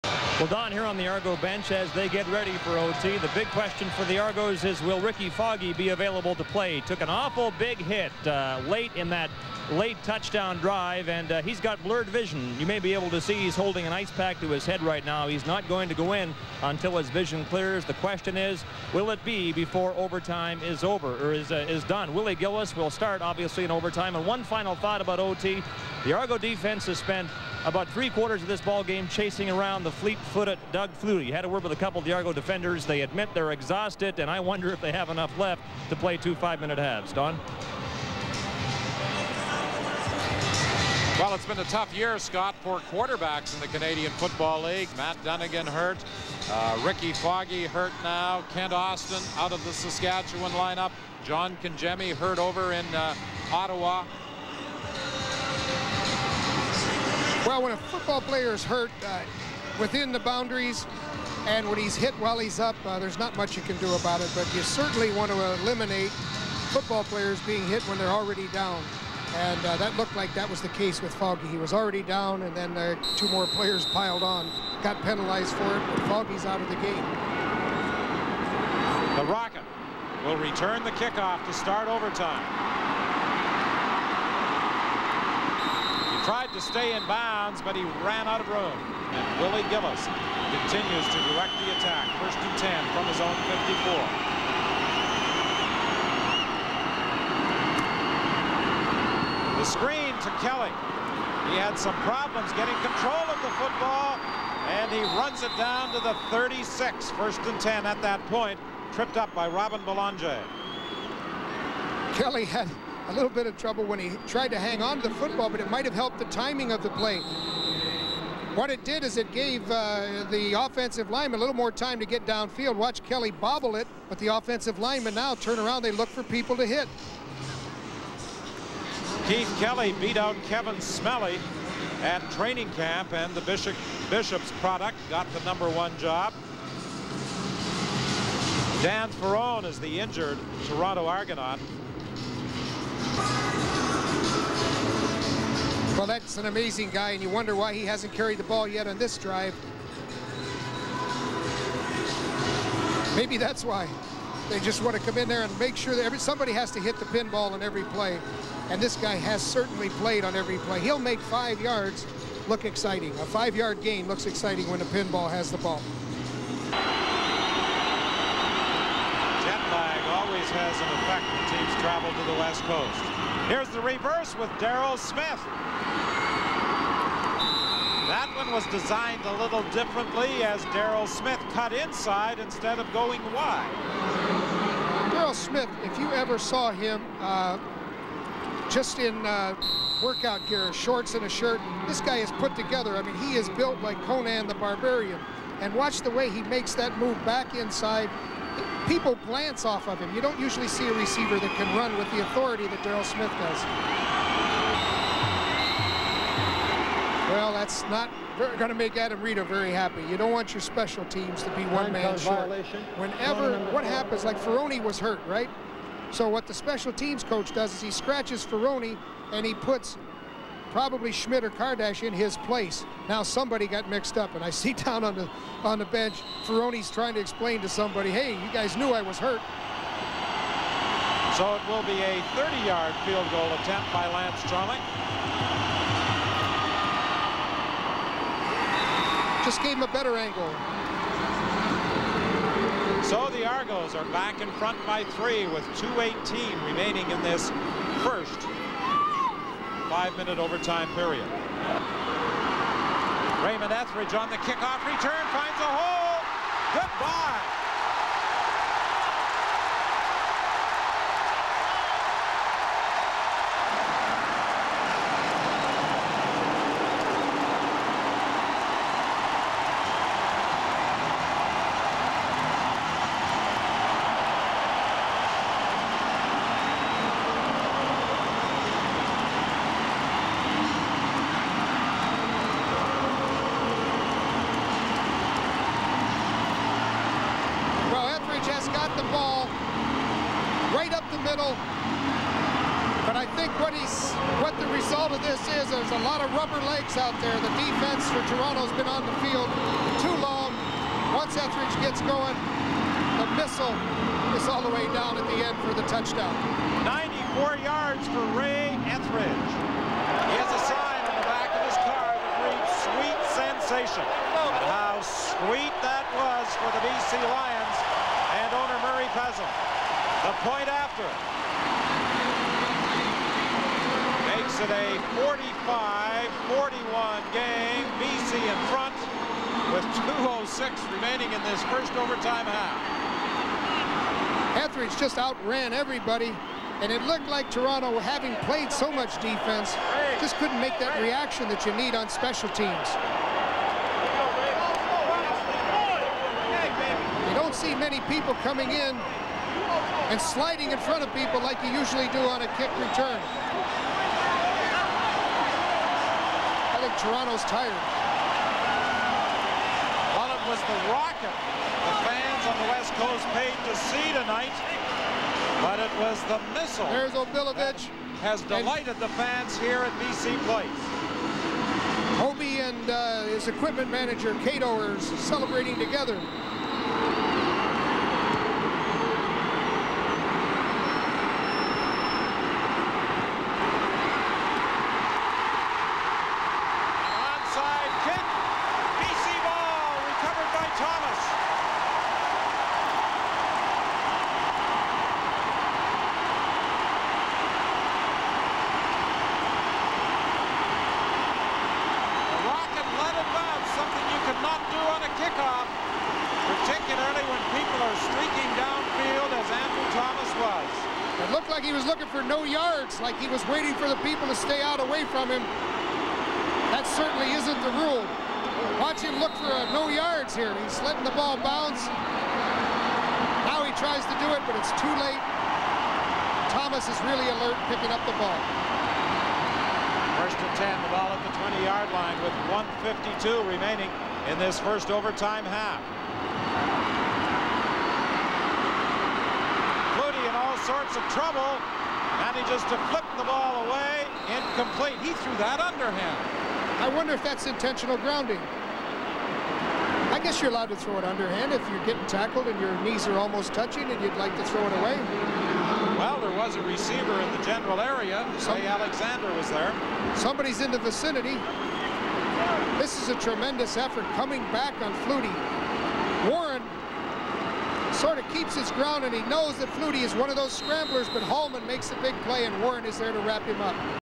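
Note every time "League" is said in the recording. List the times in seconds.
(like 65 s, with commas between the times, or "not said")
44 s.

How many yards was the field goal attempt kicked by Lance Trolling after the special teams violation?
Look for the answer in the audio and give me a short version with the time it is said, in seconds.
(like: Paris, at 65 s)
30, at 232 s.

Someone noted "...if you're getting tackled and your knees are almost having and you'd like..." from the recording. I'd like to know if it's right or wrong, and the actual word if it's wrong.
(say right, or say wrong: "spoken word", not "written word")
wrong: "touching", not "having".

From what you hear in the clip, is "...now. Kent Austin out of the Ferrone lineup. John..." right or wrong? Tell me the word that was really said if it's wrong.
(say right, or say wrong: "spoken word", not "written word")
wrong: "Saskatchewan", not "Ferrone".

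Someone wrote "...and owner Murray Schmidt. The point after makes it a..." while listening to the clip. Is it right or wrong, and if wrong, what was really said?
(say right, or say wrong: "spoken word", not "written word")
wrong: "Pezim", not "Schmidt".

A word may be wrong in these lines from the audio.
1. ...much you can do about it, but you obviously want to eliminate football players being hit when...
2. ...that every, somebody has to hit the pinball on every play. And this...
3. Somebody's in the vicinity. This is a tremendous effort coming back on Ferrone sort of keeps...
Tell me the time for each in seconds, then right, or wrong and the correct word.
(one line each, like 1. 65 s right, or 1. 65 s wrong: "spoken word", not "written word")
1. 63 s wrong: "certainly", not "obviously"
2. 155 s right
3. 460 s wrong: "Flutie", not "Ferrone".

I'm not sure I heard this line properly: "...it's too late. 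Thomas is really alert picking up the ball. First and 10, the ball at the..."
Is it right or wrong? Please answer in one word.
right.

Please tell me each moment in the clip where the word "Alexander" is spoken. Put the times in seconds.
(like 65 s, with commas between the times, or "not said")
458 s.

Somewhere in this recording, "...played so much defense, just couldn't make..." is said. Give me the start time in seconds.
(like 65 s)
338 s.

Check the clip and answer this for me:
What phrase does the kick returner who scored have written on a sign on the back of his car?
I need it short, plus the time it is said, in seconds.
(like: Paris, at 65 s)
sweet sensation, at 312 s.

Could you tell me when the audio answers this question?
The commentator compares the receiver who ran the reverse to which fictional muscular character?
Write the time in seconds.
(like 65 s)
194 s.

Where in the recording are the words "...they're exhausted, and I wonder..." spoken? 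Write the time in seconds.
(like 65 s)
33 s.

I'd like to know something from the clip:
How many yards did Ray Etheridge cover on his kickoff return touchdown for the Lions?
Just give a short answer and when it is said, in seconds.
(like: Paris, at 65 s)
94, at 306 s.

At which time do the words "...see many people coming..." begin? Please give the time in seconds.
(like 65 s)
347 s.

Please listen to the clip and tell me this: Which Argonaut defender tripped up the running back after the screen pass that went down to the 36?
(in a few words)
Robin Belanger.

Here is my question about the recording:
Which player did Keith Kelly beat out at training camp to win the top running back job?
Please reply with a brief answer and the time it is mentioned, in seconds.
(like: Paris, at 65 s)
Kevin Smellie, at 130 s.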